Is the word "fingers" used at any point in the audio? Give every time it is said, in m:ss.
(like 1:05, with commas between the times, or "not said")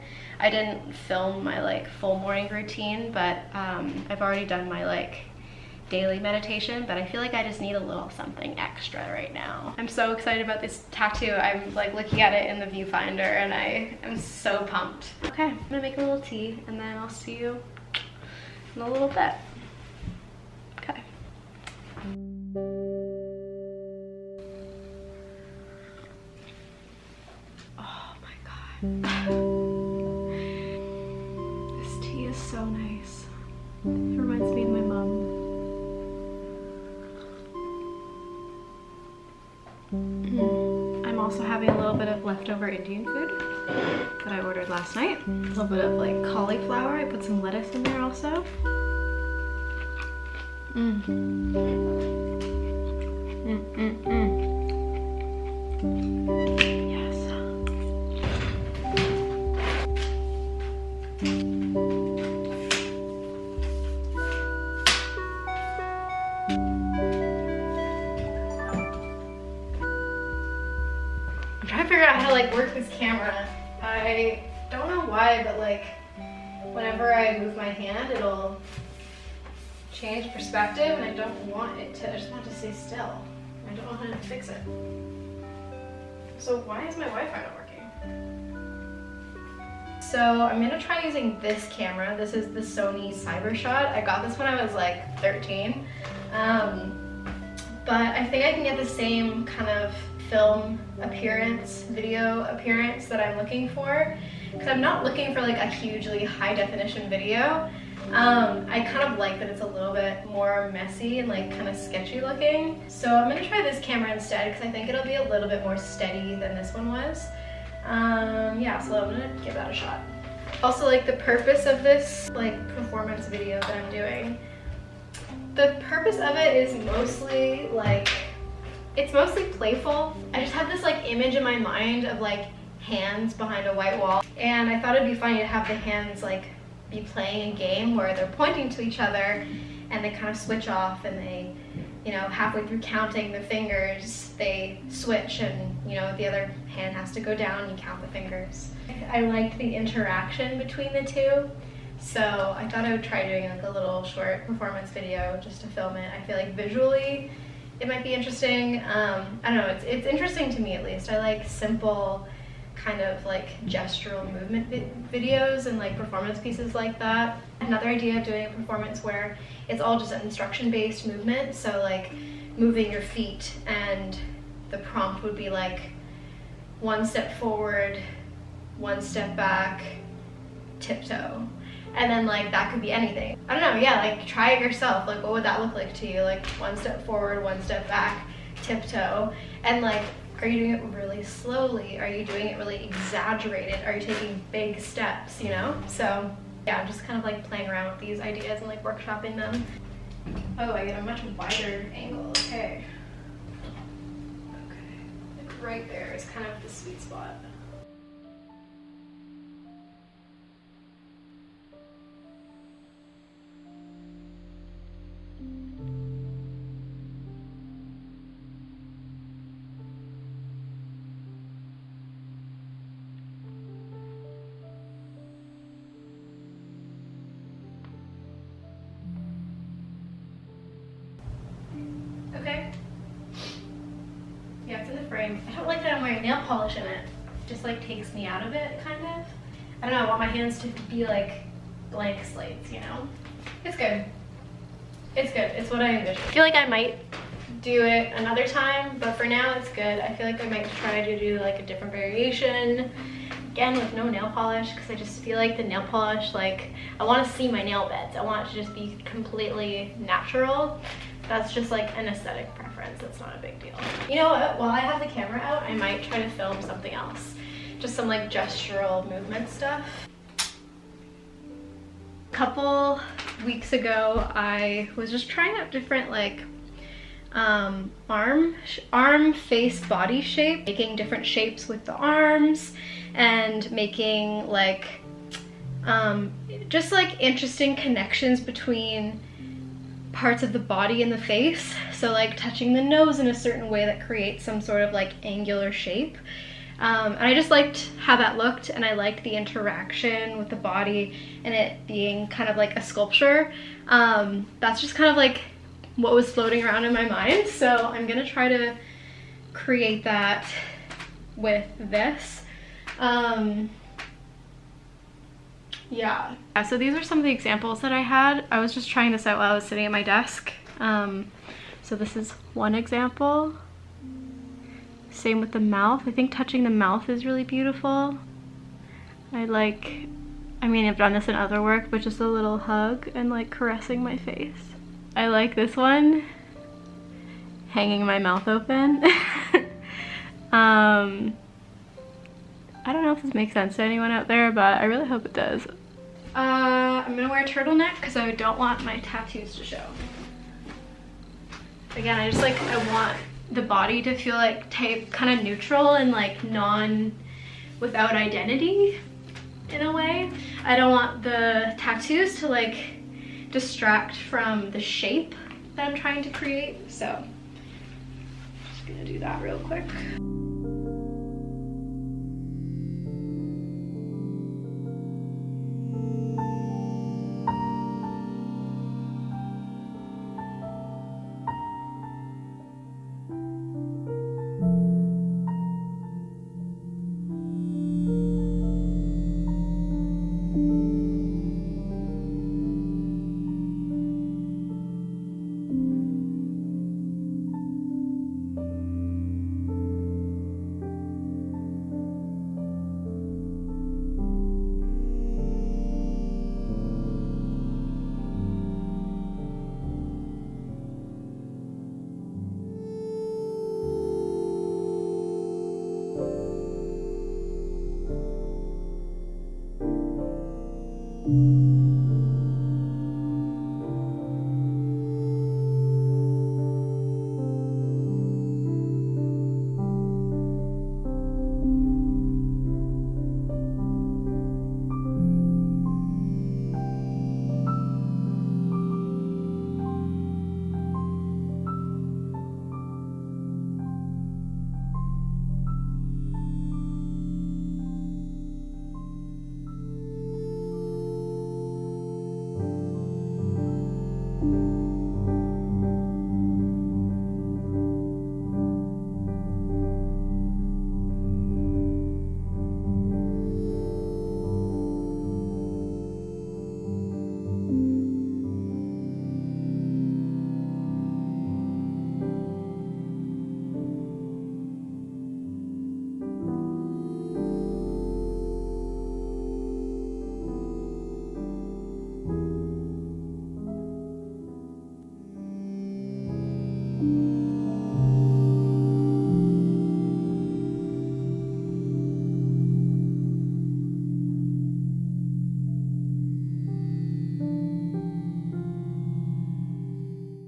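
2:23, 2:28.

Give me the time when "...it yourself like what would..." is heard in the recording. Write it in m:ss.
3:04.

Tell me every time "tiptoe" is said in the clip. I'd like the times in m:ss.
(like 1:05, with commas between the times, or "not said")
3:00, 3:08.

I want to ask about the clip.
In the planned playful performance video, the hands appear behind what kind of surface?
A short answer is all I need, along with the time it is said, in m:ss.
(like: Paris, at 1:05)
white wall, at 2:13.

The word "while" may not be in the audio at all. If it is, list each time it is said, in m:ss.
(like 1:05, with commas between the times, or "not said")
4:24, 5:19.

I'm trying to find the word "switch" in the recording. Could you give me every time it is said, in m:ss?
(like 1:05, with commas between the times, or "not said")
2:20, 2:24.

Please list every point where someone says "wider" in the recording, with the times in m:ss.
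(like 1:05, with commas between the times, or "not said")
3:21.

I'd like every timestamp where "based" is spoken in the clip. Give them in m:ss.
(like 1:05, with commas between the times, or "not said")
2:50.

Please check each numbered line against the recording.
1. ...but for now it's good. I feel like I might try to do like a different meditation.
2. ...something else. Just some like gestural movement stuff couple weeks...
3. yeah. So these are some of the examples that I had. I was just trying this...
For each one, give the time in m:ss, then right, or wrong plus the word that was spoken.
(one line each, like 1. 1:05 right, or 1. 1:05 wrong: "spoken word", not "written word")
1. 4:08 wrong: "variation", not "meditation"
2. 4:26 right
3. 5:16 right.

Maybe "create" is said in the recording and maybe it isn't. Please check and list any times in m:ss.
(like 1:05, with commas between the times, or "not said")
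4:54, 5:09, 6:06.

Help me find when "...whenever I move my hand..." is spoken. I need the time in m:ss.
1:16.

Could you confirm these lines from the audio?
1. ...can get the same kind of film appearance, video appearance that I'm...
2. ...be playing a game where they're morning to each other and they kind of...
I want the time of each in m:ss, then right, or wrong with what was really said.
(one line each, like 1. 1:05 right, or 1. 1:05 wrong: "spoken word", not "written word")
1. 1:38 right
2. 2:16 wrong: "pointing", not "morning".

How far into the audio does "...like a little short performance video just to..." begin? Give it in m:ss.
2:33.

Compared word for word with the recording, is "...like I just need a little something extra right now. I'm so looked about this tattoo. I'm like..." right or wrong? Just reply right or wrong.
wrong.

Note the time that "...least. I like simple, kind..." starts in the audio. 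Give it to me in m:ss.
2:40.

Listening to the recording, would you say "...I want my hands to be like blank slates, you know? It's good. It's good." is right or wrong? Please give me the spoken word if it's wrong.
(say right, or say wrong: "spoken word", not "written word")
right.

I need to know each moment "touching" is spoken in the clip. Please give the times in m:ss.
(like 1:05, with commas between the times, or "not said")
4:52, 5:26.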